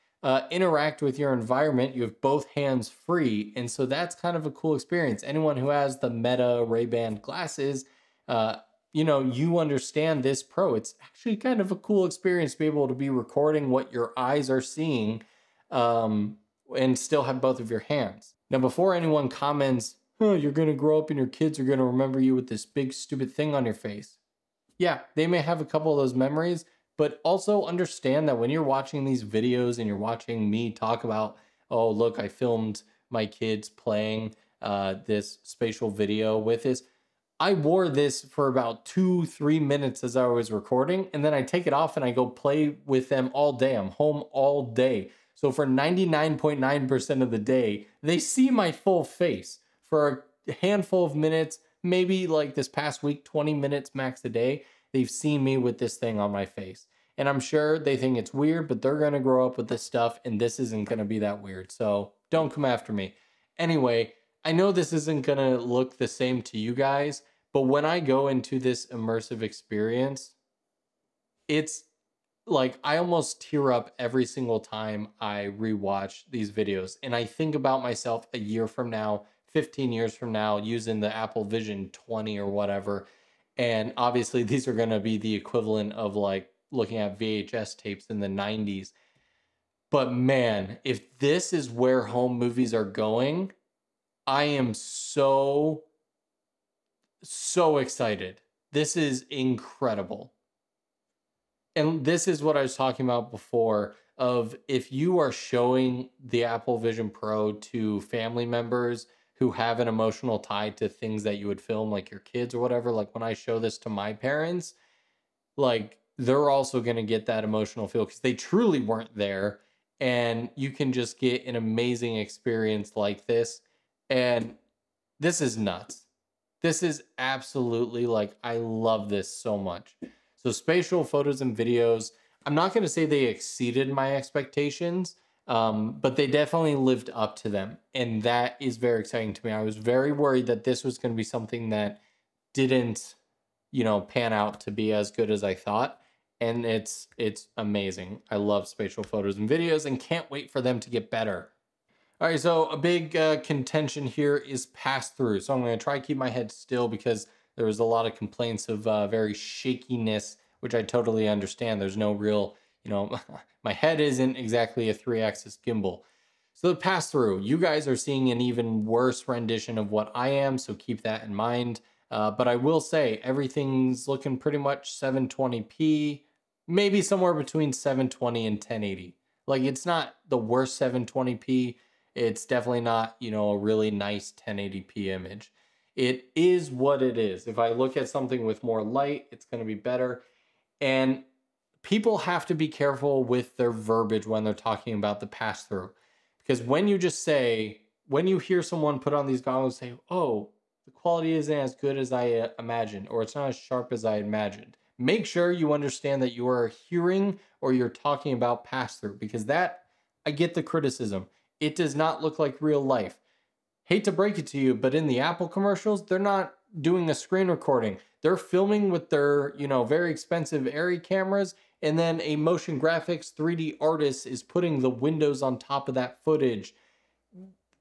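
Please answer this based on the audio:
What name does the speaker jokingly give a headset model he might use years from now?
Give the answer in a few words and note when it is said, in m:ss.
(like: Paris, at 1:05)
Apple Vision 20, at 1:21.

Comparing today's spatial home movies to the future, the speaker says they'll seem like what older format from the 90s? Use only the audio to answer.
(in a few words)
VHS tapes.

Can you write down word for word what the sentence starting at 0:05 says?
Anyone who has the Meta Ray-Ban glasses, uh, you know, you understand this pro.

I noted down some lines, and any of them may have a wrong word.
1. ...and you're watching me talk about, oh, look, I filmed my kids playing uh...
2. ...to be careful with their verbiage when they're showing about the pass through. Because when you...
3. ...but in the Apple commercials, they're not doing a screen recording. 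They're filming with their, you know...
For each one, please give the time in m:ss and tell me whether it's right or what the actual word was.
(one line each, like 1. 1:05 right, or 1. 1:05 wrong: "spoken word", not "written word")
1. 0:29 right
2. 3:12 wrong: "talking", not "showing"
3. 3:34 right.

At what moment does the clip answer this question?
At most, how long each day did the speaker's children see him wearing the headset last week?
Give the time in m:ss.
0:53.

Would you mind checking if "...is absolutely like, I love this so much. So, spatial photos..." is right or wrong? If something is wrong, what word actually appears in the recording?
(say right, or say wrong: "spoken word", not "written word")
right.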